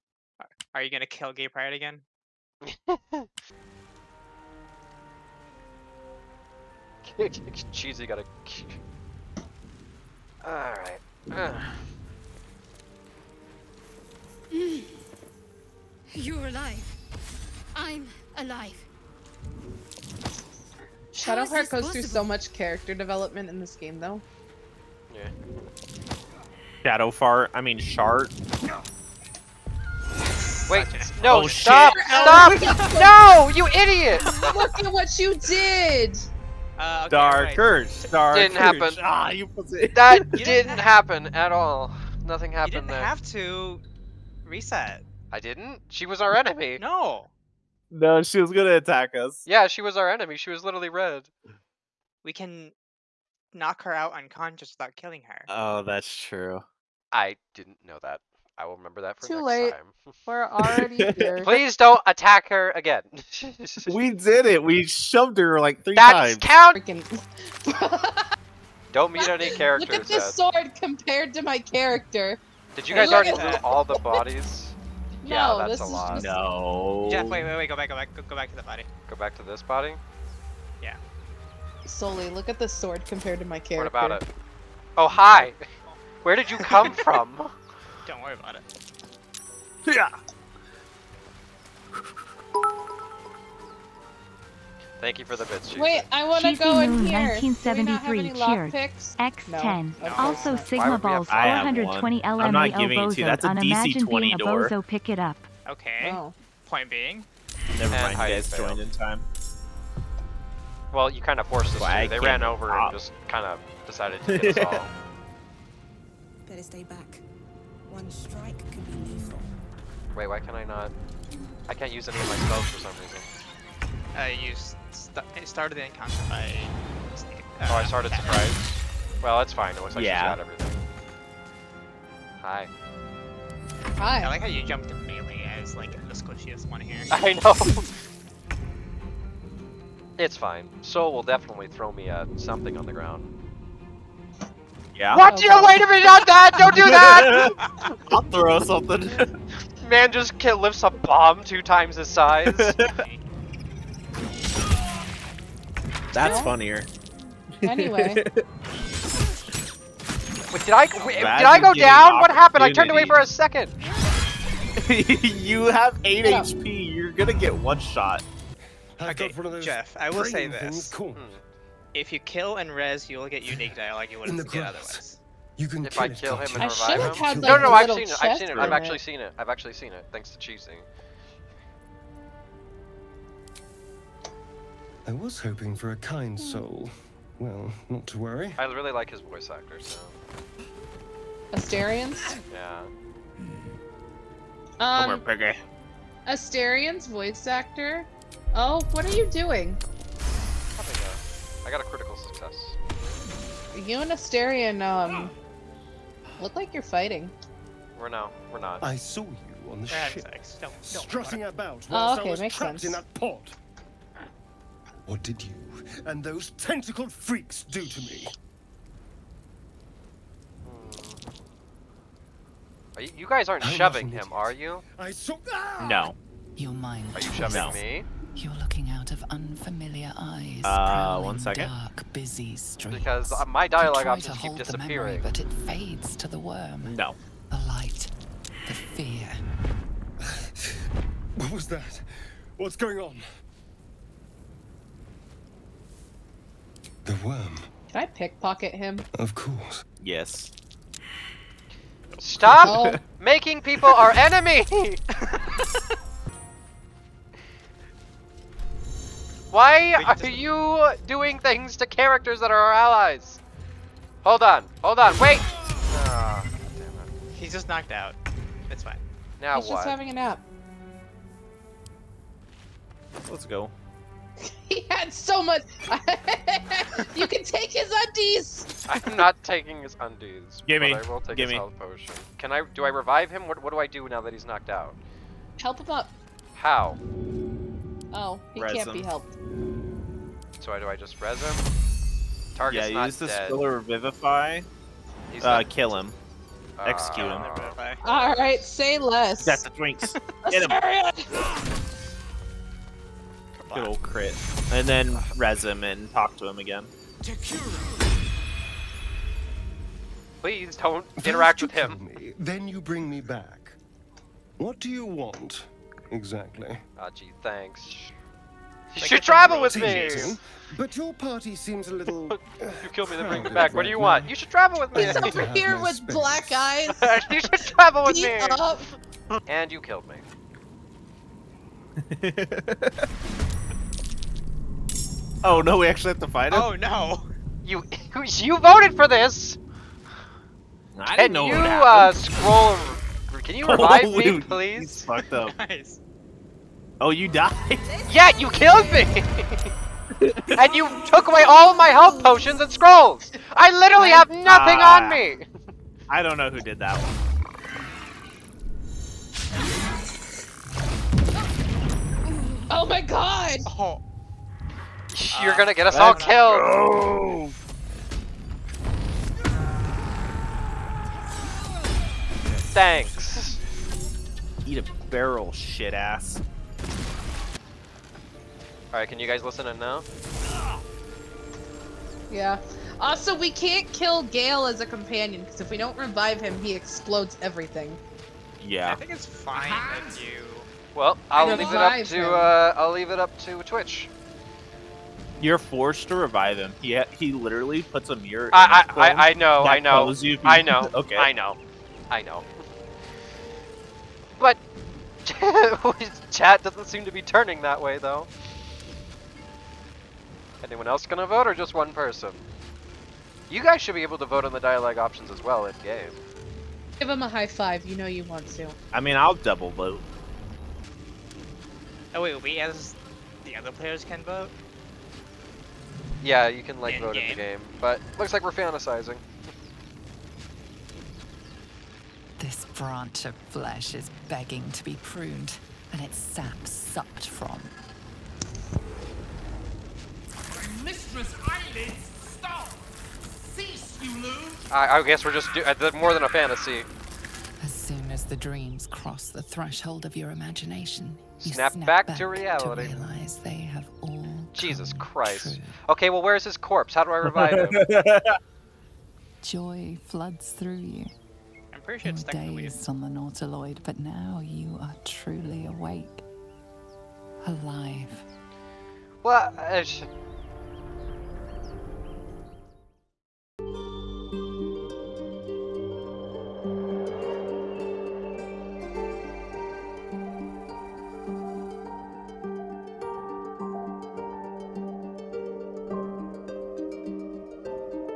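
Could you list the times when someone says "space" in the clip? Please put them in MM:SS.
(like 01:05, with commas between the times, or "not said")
05:25.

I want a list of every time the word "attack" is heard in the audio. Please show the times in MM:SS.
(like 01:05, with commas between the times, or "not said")
00:48, 01:02.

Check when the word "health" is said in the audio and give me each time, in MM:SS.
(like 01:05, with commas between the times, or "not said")
04:41, 05:51.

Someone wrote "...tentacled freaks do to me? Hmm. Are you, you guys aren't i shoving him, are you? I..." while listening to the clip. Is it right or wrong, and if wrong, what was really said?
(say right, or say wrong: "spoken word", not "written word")
right.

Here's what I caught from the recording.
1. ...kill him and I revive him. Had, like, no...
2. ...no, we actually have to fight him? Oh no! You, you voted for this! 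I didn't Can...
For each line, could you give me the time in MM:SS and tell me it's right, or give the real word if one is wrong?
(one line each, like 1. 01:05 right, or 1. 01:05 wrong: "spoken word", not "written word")
1. 02:56 right
2. 05:35 right.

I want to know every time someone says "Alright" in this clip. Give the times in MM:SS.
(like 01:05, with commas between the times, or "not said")
00:10, 06:18.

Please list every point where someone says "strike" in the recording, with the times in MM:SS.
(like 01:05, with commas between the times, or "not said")
01:58.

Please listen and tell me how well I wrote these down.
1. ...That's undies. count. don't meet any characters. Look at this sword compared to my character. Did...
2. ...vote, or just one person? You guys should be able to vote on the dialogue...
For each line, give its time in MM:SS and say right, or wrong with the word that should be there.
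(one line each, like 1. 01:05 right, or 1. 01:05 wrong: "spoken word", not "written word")
1. 01:05 wrong: "times", not "undies"
2. 06:51 right.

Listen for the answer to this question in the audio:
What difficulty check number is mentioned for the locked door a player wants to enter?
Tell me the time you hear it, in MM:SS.
01:43.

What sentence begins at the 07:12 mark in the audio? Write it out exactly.
branch of flesh is begging to be pruned and its sap sucked from.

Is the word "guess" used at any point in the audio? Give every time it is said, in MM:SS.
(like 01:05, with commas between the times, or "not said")
07:25.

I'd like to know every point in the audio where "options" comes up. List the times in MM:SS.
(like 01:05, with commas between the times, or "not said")
03:54, 06:54.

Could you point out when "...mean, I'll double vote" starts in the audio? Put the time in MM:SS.
06:58.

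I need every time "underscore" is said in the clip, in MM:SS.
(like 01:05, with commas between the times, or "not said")
not said.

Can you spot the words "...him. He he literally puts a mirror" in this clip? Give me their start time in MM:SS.
06:36.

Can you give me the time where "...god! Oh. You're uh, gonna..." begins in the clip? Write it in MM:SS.
06:02.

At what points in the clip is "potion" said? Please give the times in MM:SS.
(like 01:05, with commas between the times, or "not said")
04:41, 05:52.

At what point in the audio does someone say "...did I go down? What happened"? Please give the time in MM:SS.
02:41.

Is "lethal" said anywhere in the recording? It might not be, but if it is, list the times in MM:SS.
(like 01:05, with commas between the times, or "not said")
01:59.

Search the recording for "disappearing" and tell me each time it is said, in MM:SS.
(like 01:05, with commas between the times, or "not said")
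03:54.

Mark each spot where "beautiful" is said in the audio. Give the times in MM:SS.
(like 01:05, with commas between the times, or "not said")
not said.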